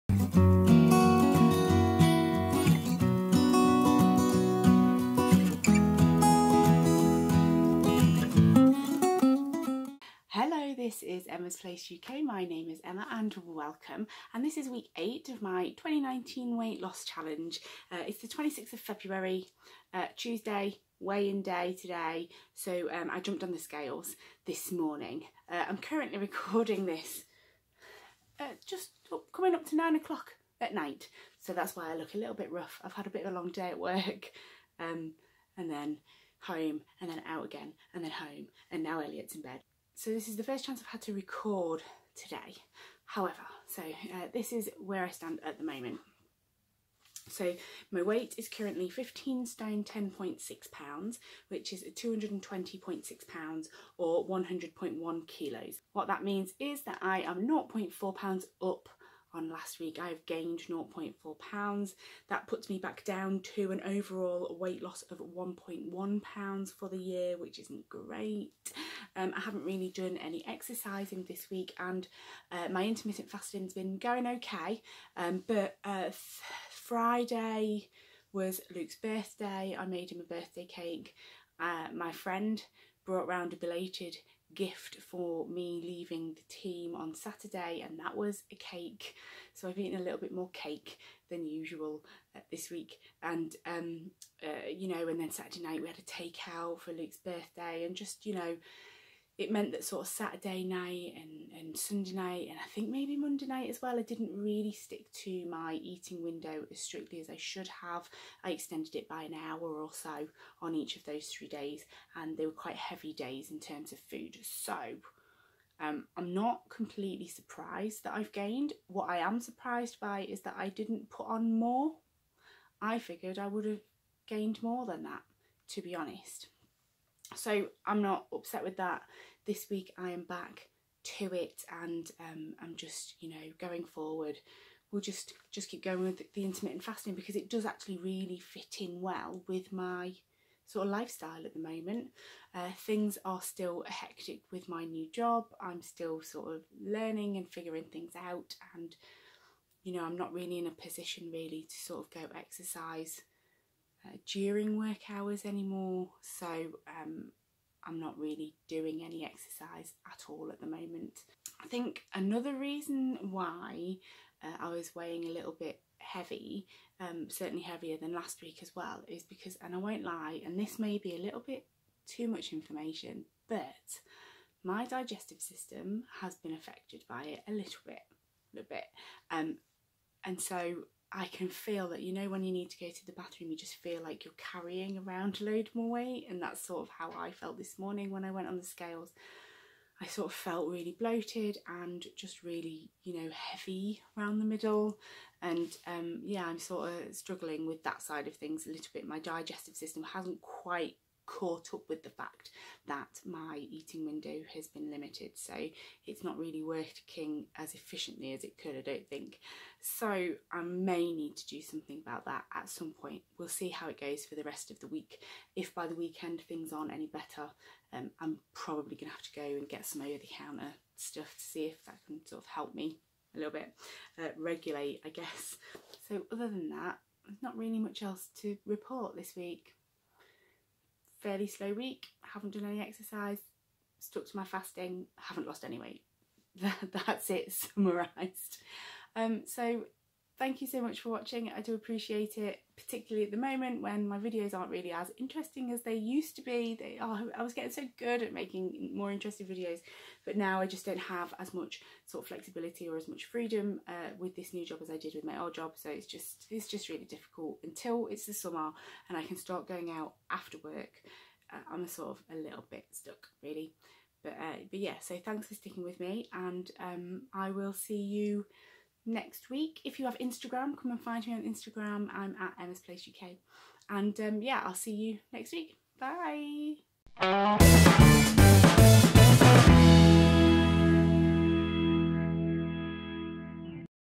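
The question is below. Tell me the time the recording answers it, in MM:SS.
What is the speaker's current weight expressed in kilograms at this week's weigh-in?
00:54.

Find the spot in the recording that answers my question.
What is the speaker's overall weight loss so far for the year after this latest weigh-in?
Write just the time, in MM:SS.
01:05.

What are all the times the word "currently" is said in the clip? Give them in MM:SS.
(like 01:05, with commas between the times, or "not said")
00:25, 00:48.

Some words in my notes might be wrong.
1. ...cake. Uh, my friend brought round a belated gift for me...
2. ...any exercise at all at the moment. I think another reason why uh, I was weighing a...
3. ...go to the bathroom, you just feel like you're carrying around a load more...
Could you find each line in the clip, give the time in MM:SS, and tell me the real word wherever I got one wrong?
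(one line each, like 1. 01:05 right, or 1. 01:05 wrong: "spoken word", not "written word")
1. 01:20 right
2. 02:39 right
3. 03:02 right.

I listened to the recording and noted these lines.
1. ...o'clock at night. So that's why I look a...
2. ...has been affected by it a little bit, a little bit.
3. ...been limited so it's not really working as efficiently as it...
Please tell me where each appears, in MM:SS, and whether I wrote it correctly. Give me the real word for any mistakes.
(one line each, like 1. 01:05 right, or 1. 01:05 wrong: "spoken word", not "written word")
1. 00:29 right
2. 02:56 right
3. 03:24 right.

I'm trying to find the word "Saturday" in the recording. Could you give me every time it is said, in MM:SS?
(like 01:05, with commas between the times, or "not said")
01:27, 01:35, 01:40.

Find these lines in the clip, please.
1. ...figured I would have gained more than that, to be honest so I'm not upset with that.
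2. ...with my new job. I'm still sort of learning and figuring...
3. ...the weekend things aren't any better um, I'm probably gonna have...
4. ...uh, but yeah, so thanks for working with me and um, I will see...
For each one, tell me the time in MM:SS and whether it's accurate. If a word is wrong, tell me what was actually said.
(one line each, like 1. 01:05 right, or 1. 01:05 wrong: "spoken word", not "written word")
1. 02:02 right
2. 02:24 right
3. 03:35 right
4. 04:24 wrong: "sticking", not "working".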